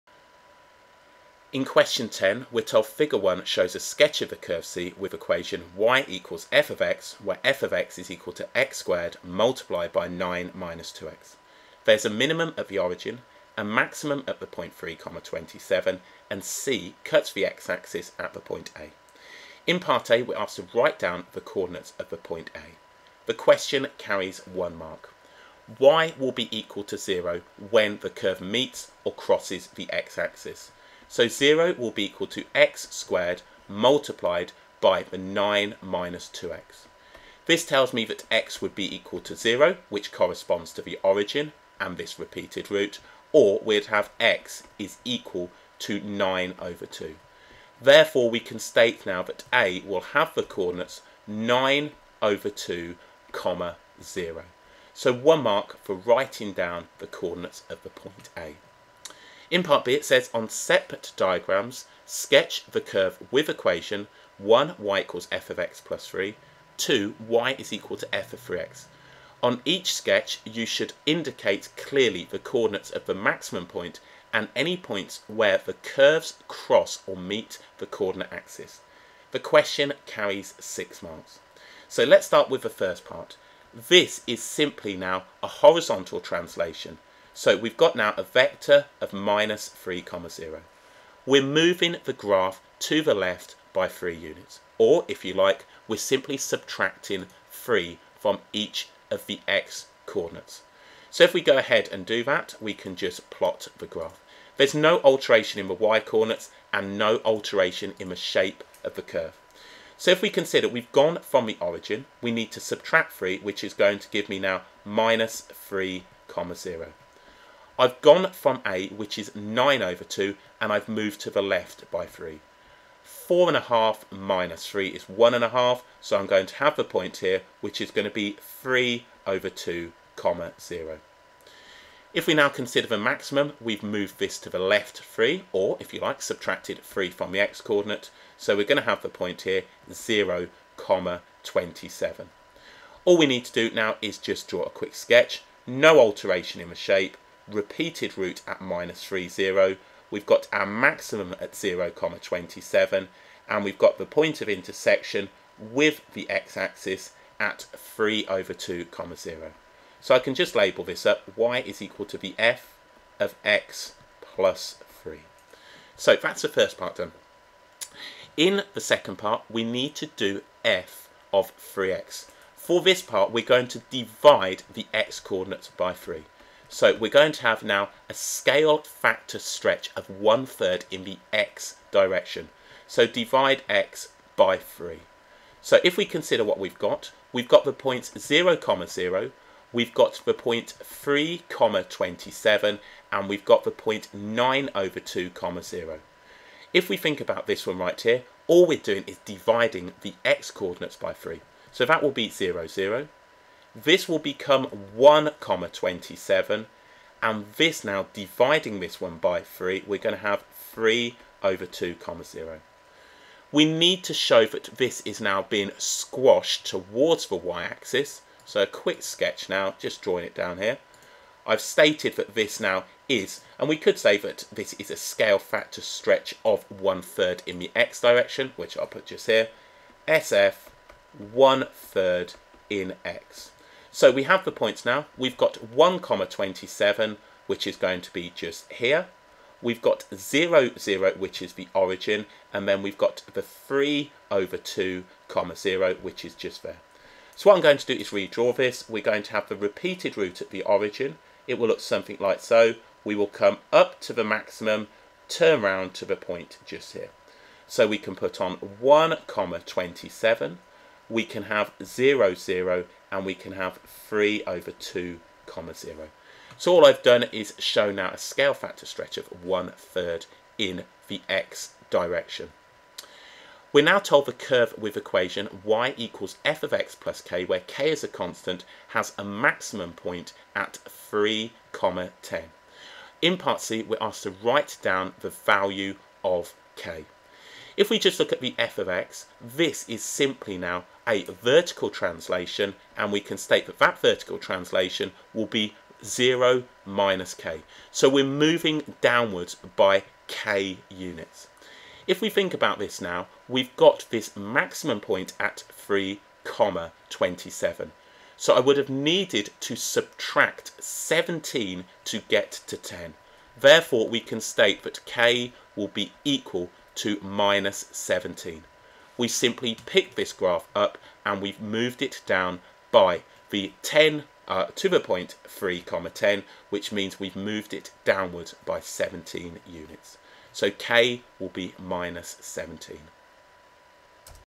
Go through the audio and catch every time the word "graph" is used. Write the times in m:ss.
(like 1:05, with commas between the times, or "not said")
1:32, 1:43, 5:20.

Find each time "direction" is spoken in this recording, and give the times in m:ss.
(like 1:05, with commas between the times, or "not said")
3:01, 3:48, 4:31.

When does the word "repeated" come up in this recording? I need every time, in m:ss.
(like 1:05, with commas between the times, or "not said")
0:42, 2:27, 4:09.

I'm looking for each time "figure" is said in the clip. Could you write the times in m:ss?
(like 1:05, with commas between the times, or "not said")
0:02.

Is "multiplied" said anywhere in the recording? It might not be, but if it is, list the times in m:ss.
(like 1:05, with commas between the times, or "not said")
0:09, 0:33.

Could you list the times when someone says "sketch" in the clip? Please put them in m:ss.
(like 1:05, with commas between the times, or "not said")
0:03, 1:02, 1:09, 2:24, 3:39.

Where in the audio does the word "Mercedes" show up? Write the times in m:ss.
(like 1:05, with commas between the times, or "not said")
not said.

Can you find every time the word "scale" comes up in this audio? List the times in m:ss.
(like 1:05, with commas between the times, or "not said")
2:58, 3:44, 4:28.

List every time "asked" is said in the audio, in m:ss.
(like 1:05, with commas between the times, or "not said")
0:20, 4:43.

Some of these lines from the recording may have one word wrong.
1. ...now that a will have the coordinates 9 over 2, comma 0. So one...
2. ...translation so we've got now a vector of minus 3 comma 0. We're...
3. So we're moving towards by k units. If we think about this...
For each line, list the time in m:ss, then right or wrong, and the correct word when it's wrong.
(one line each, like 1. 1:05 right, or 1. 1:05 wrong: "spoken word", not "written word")
1. 0:49 right
2. 1:26 right
3. 4:57 wrong: "downwards", not "towards".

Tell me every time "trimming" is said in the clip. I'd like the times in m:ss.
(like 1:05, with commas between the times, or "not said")
not said.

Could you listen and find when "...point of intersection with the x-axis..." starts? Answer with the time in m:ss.
2:34.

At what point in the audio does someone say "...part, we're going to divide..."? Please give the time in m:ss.
2:53.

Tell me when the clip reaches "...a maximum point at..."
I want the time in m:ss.
4:39.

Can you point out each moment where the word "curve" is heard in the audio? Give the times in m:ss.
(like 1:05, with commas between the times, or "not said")
0:04, 0:28, 1:02, 1:15, 1:49, 4:34.